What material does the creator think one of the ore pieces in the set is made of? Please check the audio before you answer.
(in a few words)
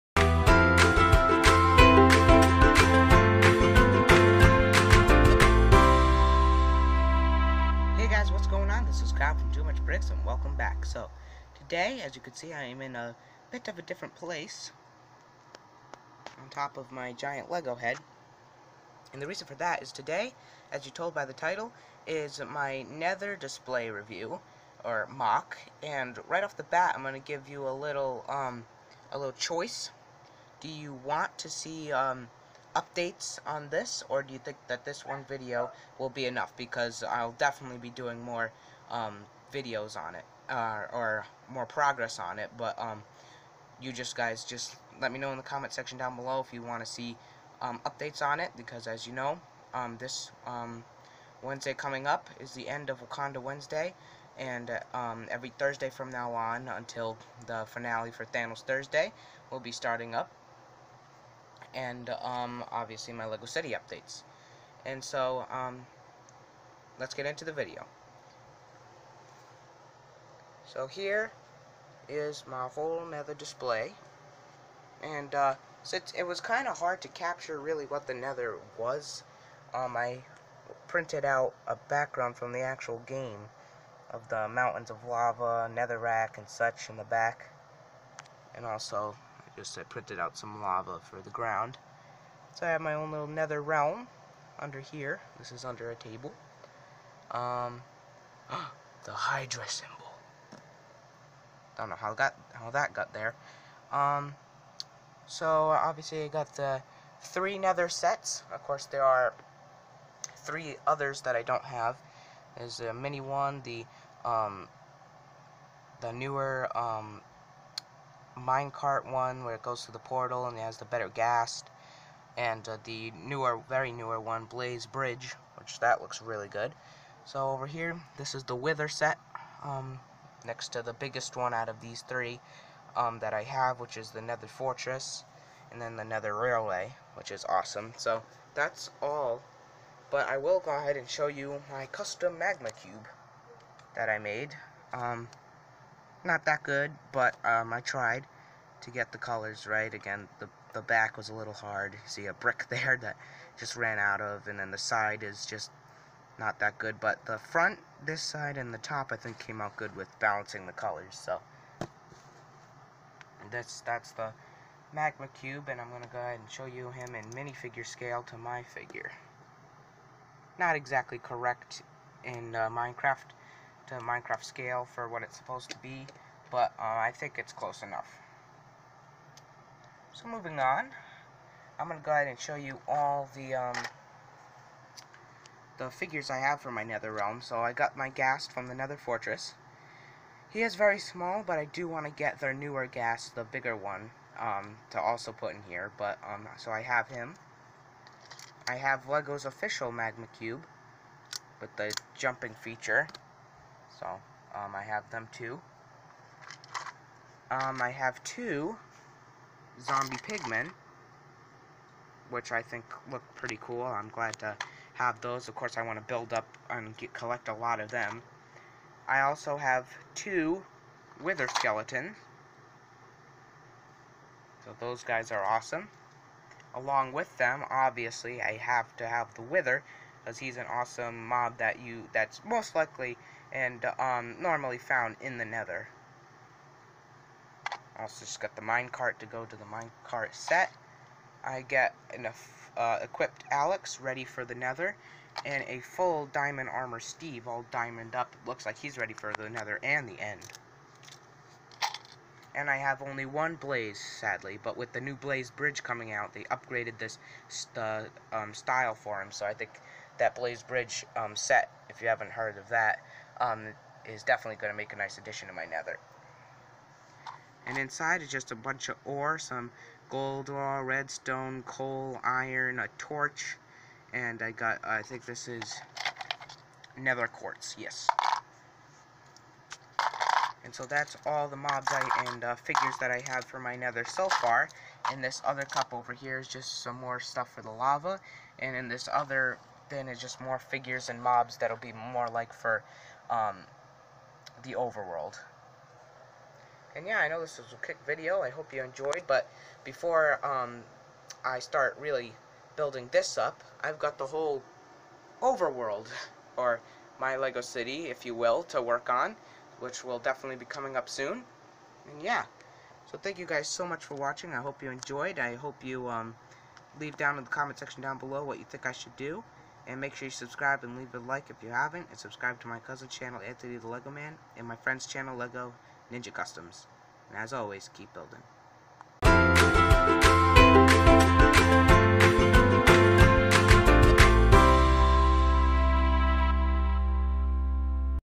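nether quartz.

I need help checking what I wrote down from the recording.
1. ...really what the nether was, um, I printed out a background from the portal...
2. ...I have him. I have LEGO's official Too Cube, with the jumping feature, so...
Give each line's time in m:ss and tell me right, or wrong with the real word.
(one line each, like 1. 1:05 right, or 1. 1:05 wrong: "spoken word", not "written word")
1. 1:17 wrong: "actual", not "portal"
2. 3:16 wrong: "Magma", not "Too".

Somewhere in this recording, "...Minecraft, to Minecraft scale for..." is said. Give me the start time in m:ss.
2:52.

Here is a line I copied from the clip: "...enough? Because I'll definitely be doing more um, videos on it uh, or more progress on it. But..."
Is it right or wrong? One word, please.
right.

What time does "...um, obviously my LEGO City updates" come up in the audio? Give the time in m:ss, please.
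1:02.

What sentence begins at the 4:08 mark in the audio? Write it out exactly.
It looks like he's ready for the nether and the end.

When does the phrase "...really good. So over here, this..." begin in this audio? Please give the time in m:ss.
2:06.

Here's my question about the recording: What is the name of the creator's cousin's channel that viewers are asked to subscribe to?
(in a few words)
Anthony the Lego Man.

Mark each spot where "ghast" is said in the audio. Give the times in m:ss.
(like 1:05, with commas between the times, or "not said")
2:01, 3:08, 3:12.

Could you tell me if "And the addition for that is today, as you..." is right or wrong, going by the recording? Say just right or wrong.
wrong.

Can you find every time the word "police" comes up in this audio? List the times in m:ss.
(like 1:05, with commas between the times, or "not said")
not said.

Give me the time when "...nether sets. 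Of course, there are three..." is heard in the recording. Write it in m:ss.
1:47.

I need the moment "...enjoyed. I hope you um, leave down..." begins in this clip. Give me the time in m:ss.
5:14.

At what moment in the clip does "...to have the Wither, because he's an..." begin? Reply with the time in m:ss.
3:48.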